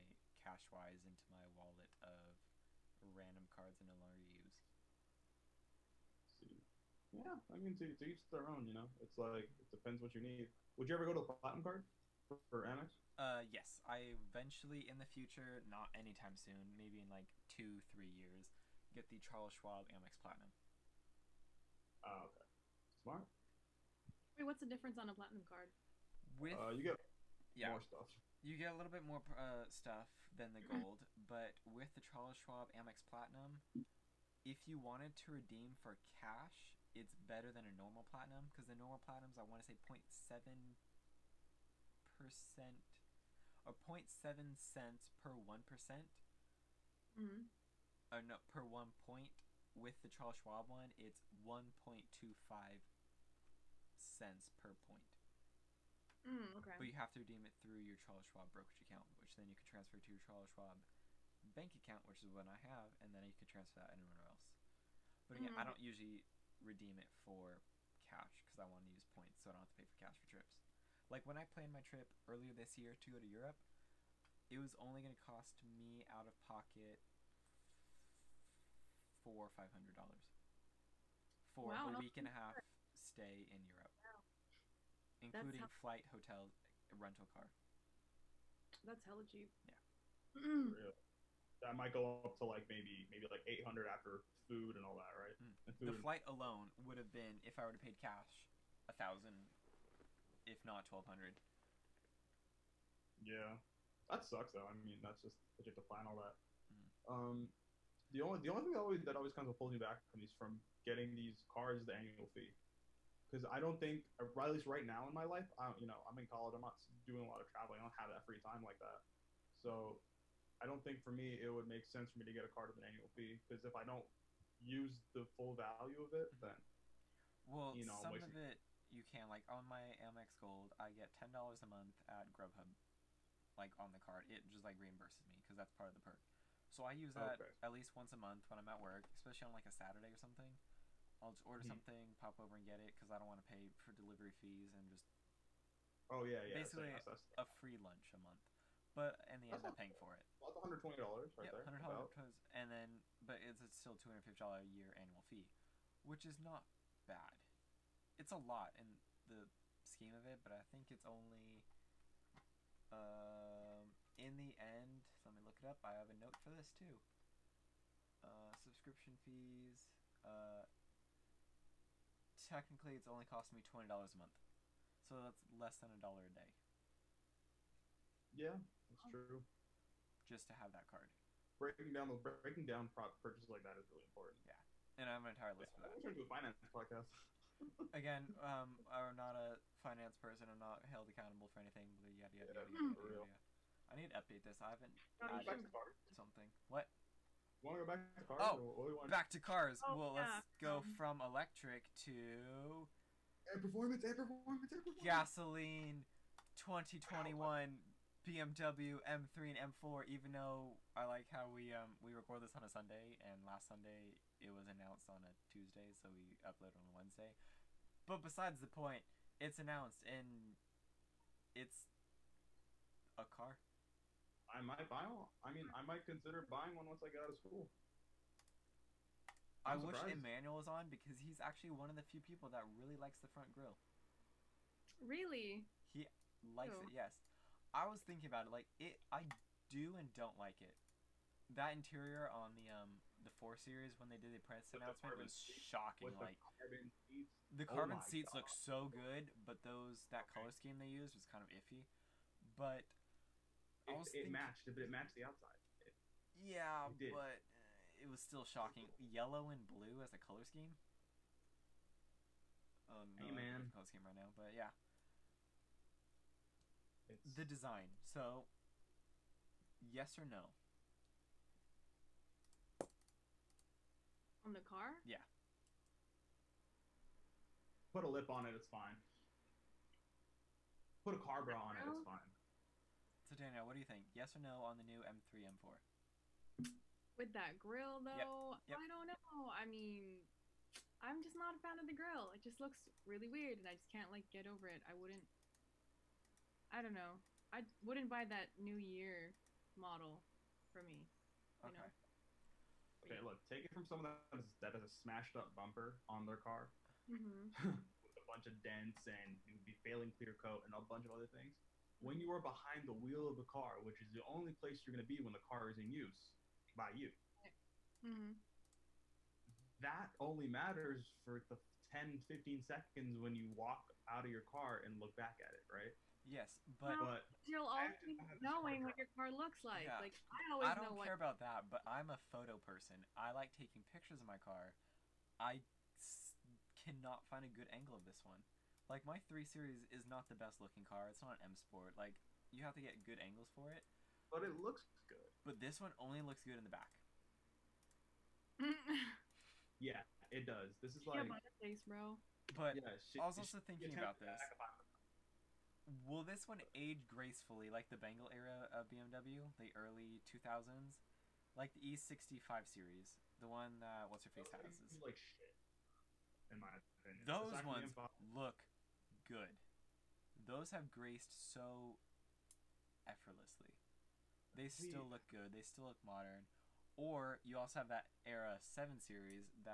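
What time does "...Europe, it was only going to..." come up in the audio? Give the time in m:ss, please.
1:13.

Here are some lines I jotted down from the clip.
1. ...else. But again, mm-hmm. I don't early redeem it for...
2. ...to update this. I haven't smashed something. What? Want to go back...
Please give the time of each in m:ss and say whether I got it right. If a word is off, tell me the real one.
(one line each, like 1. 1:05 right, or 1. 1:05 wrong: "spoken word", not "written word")
1. 1:04 wrong: "usually", not "early"
2. 3:14 wrong: "added", not "smashed".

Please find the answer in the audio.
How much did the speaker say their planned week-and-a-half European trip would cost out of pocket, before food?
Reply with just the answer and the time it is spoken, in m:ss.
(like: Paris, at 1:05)
$400-500, at 1:19.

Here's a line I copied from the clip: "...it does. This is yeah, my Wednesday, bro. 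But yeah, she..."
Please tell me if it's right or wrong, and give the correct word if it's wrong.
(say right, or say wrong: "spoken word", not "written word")
wrong: "Face", not "Wednesday".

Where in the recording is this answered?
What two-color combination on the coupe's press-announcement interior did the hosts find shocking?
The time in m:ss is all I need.
4:18.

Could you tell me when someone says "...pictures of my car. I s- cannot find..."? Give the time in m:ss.
5:33.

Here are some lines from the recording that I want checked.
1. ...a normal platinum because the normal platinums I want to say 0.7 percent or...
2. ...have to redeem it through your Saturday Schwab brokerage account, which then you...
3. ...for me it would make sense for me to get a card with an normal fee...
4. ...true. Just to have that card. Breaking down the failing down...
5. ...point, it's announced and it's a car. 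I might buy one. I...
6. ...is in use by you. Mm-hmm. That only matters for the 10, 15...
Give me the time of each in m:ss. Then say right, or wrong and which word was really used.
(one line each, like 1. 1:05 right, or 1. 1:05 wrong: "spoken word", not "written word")
1. 0:37 right
2. 0:56 wrong: "Charles", not "Saturday"
3. 2:01 wrong: "annual", not "normal"
4. 2:59 wrong: "breaking", not "failing"
5. 3:38 right
6. 5:15 right.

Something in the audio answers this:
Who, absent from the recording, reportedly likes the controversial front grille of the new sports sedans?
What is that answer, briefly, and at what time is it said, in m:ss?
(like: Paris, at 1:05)
Emmanuel, at 3:50.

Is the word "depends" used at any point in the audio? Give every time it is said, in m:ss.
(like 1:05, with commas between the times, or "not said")
0:09.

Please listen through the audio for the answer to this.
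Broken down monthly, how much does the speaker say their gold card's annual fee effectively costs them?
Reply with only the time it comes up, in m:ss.
2:53.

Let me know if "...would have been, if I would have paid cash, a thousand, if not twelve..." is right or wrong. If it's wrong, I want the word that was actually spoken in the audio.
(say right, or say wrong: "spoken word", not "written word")
right.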